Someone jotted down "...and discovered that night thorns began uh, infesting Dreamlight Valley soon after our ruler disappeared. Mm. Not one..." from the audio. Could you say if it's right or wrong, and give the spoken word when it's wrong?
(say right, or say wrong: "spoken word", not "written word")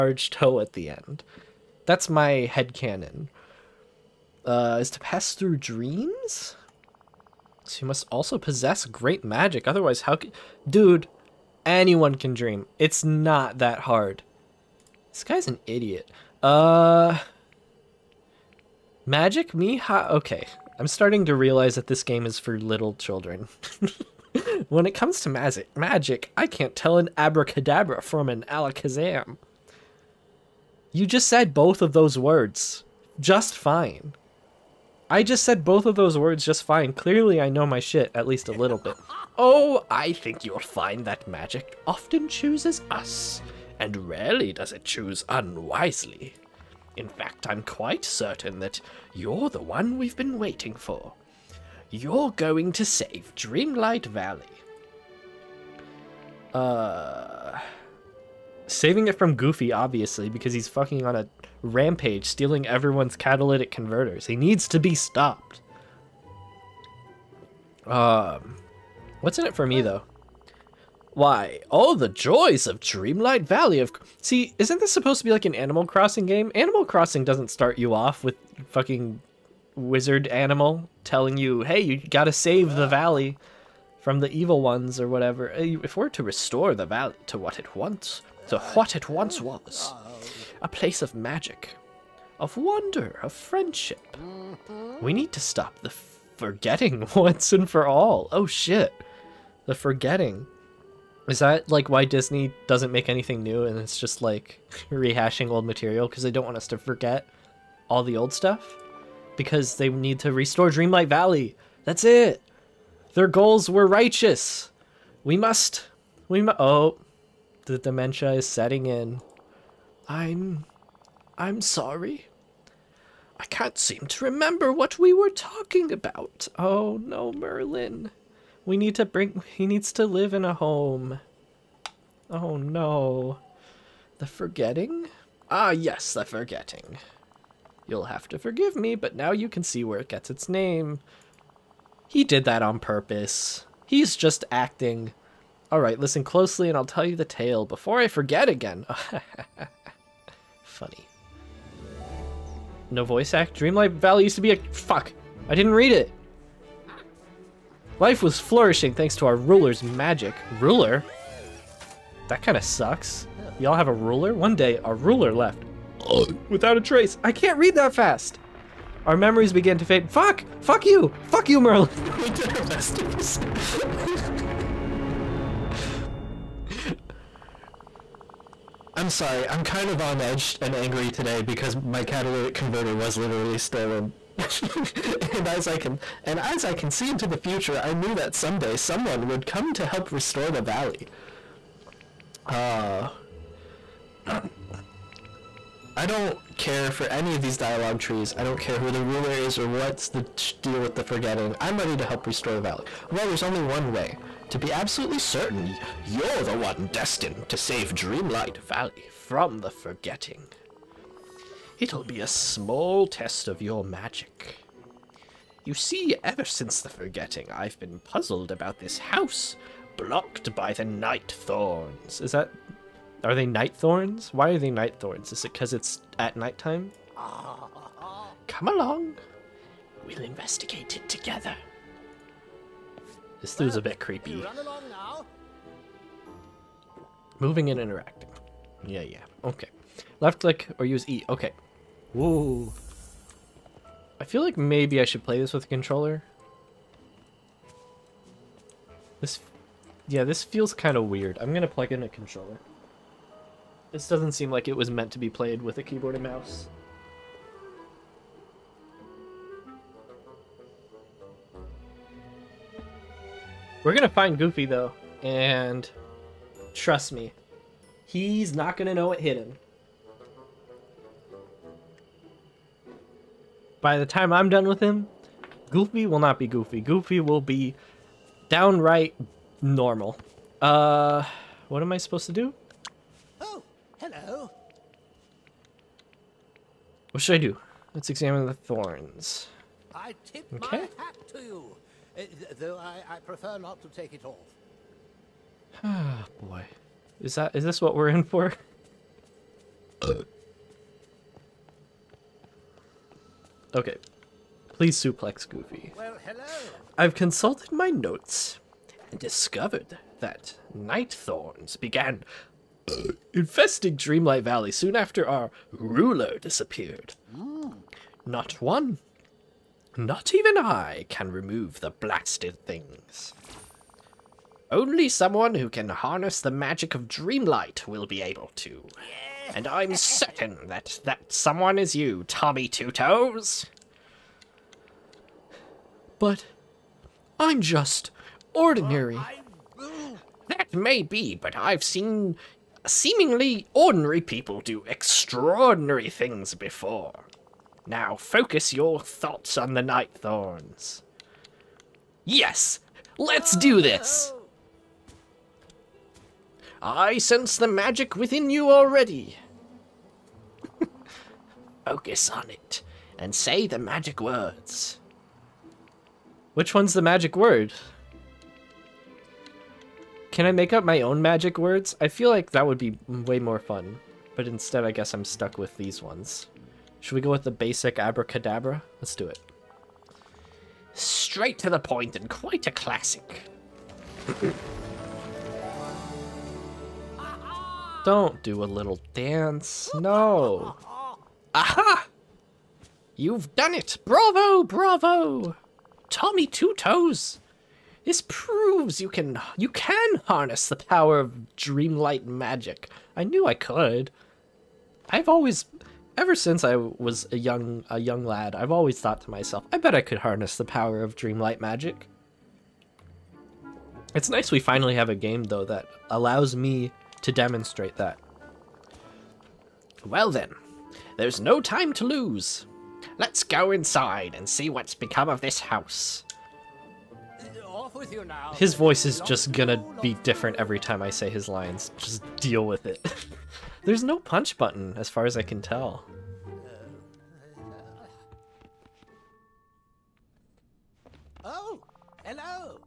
right.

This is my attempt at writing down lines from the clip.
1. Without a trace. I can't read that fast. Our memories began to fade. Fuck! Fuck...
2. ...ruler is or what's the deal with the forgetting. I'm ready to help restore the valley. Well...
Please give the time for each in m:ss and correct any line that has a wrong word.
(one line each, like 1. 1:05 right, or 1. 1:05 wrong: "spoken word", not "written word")
1. 2:46 right
2. 3:19 right.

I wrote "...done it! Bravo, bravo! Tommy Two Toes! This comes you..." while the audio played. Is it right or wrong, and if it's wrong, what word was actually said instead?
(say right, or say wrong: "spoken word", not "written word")
wrong: "proves", not "comes".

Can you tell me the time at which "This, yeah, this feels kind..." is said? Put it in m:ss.
4:09.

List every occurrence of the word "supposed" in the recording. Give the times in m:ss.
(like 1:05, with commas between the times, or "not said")
1:14, 4:41.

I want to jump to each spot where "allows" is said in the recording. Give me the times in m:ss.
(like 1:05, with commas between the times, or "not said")
6:56.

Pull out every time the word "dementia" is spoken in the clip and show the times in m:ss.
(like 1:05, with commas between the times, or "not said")
1:57.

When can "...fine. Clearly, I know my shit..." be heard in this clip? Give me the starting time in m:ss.
0:36.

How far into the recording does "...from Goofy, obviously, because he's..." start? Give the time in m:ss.
0:59.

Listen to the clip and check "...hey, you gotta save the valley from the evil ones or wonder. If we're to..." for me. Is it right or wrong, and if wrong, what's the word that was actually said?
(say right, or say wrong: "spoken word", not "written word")
wrong: "whatever", not "wonder".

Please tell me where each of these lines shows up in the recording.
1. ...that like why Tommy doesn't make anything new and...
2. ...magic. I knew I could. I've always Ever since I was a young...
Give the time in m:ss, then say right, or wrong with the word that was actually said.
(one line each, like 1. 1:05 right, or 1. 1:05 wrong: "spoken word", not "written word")
1. 1:41 wrong: "Disney", not "Tommy"
2. 6:42 right.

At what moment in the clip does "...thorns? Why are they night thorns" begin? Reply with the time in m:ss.
3:43.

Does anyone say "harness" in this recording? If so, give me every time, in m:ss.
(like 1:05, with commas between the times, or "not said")
5:25, 6:40, 6:50.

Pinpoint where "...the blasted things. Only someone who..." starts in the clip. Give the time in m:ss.
5:21.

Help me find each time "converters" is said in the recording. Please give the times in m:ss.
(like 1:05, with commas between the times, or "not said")
1:03, 3:02.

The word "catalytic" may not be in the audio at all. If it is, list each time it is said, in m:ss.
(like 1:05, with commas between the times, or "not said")
1:03, 3:02.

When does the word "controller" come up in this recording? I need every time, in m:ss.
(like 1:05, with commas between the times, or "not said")
4:05, 4:12.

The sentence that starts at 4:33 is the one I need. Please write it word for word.
By the time I'm done with him, Goofy will not be Goofy.